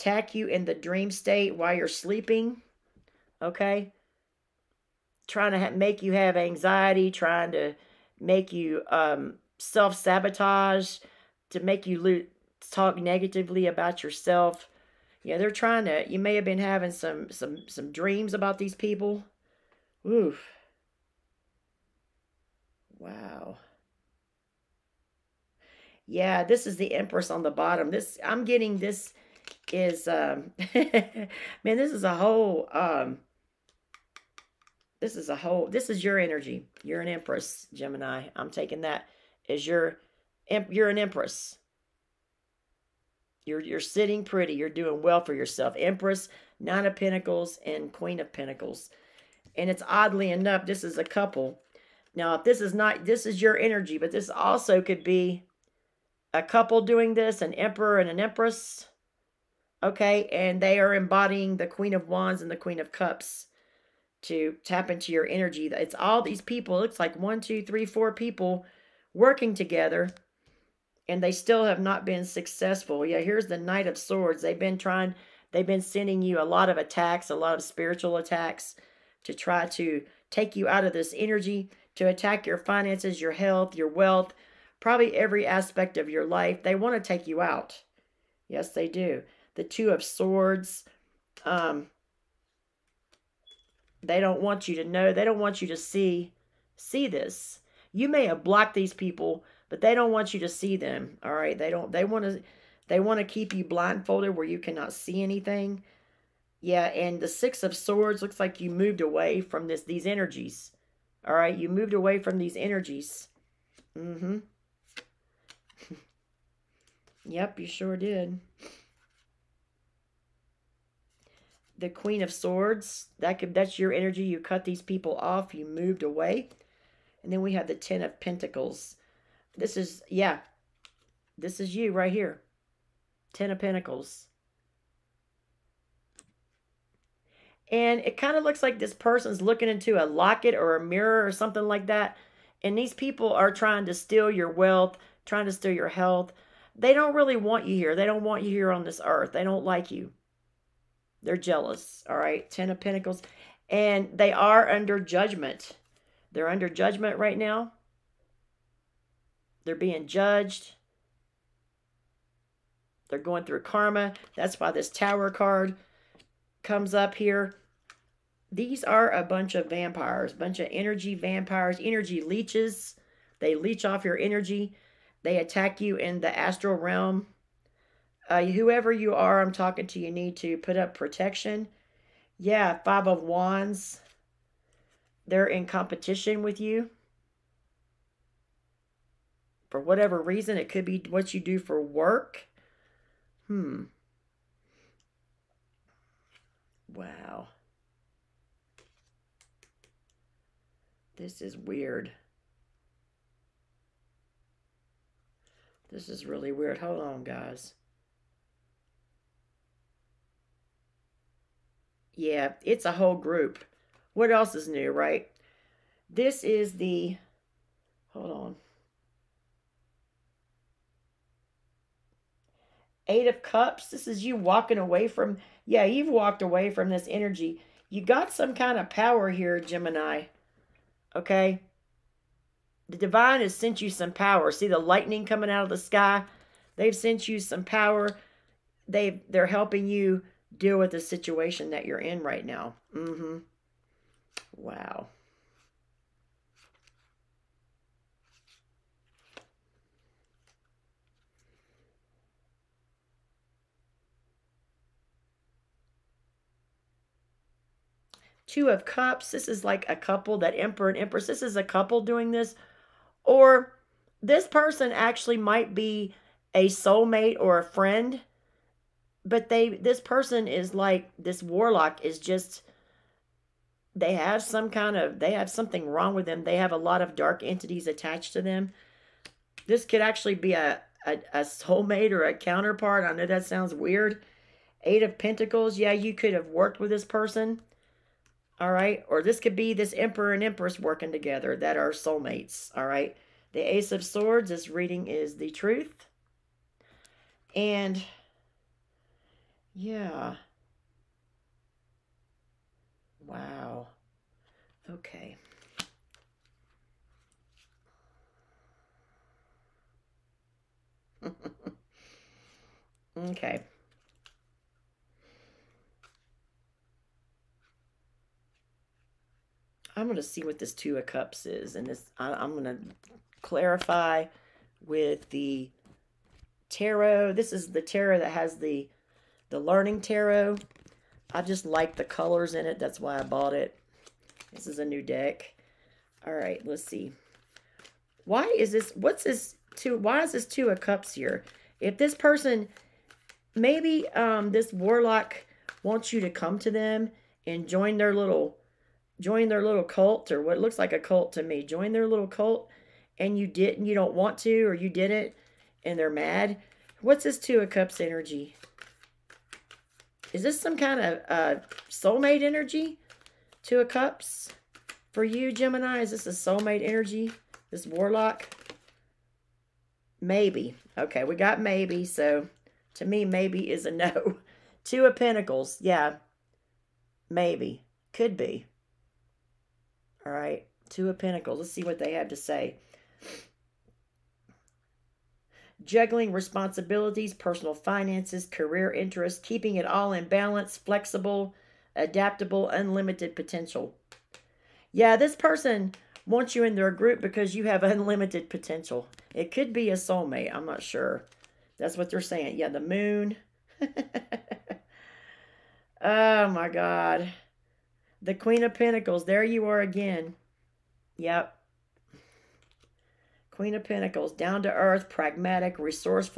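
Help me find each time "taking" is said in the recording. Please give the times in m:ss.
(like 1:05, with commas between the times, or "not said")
0:38.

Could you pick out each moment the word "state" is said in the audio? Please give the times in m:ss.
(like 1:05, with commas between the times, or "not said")
0:01.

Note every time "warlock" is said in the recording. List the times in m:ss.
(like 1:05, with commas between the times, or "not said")
4:31, 5:44, 6:07.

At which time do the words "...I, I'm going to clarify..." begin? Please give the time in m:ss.
5:22.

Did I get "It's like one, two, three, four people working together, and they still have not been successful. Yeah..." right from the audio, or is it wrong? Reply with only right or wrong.
right.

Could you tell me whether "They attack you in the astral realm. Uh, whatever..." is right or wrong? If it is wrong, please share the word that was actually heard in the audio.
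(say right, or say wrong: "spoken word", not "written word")
wrong: "whoever", not "whatever".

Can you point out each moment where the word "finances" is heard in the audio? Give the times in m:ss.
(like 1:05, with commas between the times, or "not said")
1:22, 6:27.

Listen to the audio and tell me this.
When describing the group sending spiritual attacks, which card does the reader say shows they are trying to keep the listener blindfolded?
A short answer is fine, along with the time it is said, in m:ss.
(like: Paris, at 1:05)
Two of Swords, at 1:29.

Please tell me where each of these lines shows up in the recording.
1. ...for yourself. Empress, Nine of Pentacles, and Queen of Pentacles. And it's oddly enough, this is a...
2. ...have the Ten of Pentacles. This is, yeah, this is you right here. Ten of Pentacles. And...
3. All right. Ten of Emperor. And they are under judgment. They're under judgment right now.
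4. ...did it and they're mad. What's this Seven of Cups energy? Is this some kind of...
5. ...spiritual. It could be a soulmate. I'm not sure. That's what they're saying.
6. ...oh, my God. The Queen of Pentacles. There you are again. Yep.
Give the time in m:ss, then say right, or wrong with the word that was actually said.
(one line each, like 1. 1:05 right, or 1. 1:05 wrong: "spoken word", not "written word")
1. 0:45 right
2. 2:07 right
3. 2:32 wrong: "Pentacles", not "Emperor"
4. 5:54 wrong: "Two", not "Seven"
5. 6:38 wrong: "potential", not "spiritual"
6. 6:46 right.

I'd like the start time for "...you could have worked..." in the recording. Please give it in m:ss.
4:45.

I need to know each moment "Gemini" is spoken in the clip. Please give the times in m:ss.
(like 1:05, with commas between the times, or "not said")
0:37, 3:49, 6:05.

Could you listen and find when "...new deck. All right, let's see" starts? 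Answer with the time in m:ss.
5:34.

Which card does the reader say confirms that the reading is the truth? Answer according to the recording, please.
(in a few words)
Ace of Swords.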